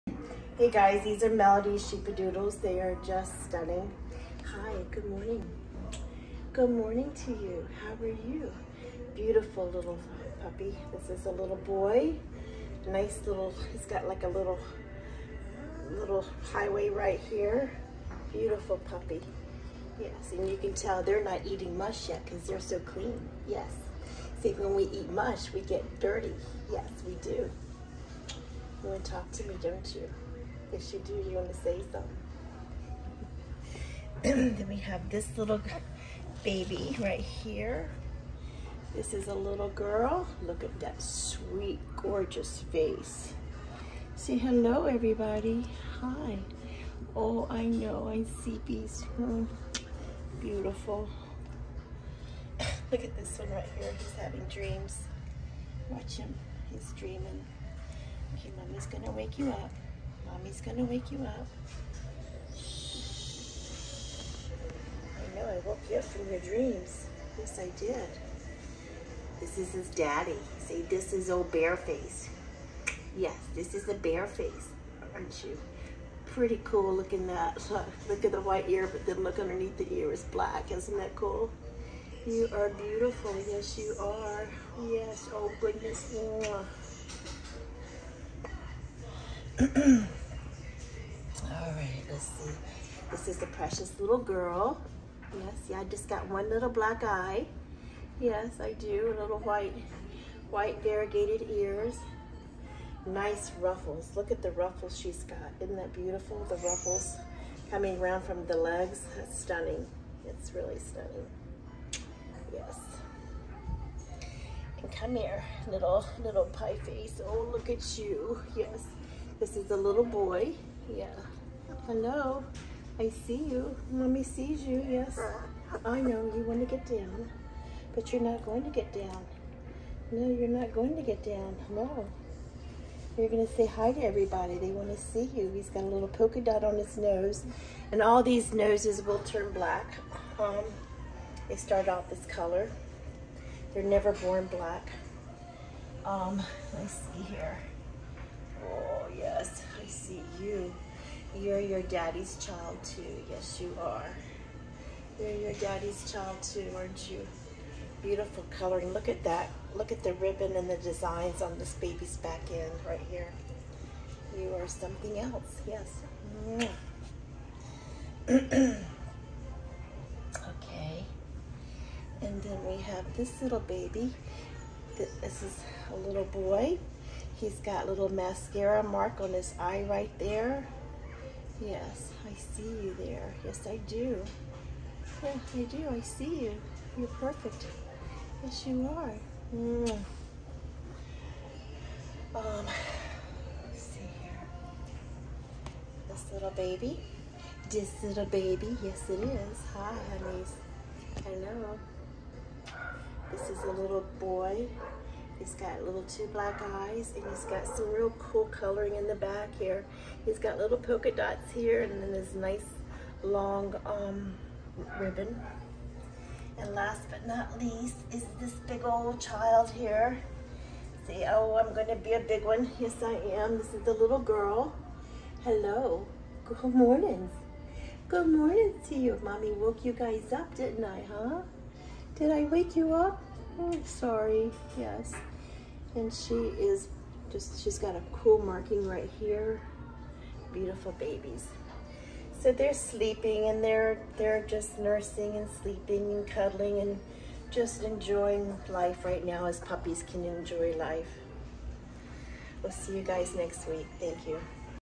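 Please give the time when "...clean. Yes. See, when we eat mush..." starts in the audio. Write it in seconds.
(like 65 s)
22 s.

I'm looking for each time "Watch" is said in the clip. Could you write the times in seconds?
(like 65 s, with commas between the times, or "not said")
55 s.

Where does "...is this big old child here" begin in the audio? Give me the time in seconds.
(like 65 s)
218 s.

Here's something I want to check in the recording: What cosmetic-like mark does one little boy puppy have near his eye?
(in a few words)
Mascara mark.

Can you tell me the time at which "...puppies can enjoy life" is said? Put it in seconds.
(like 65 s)
249 s.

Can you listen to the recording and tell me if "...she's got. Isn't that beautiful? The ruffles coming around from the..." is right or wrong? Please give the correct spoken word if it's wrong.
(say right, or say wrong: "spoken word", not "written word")
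right.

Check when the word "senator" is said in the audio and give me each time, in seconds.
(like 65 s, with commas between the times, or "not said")
not said.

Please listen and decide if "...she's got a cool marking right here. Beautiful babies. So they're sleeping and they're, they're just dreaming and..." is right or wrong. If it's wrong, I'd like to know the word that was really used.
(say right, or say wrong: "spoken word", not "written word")
wrong: "nursing", not "dreaming".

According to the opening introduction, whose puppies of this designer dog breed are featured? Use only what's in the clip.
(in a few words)
Melody's.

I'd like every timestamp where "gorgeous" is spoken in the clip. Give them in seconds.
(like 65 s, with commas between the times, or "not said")
41 s.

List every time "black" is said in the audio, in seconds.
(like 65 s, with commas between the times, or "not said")
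80 s, 96 s, 139 s, 144 s, 206 s.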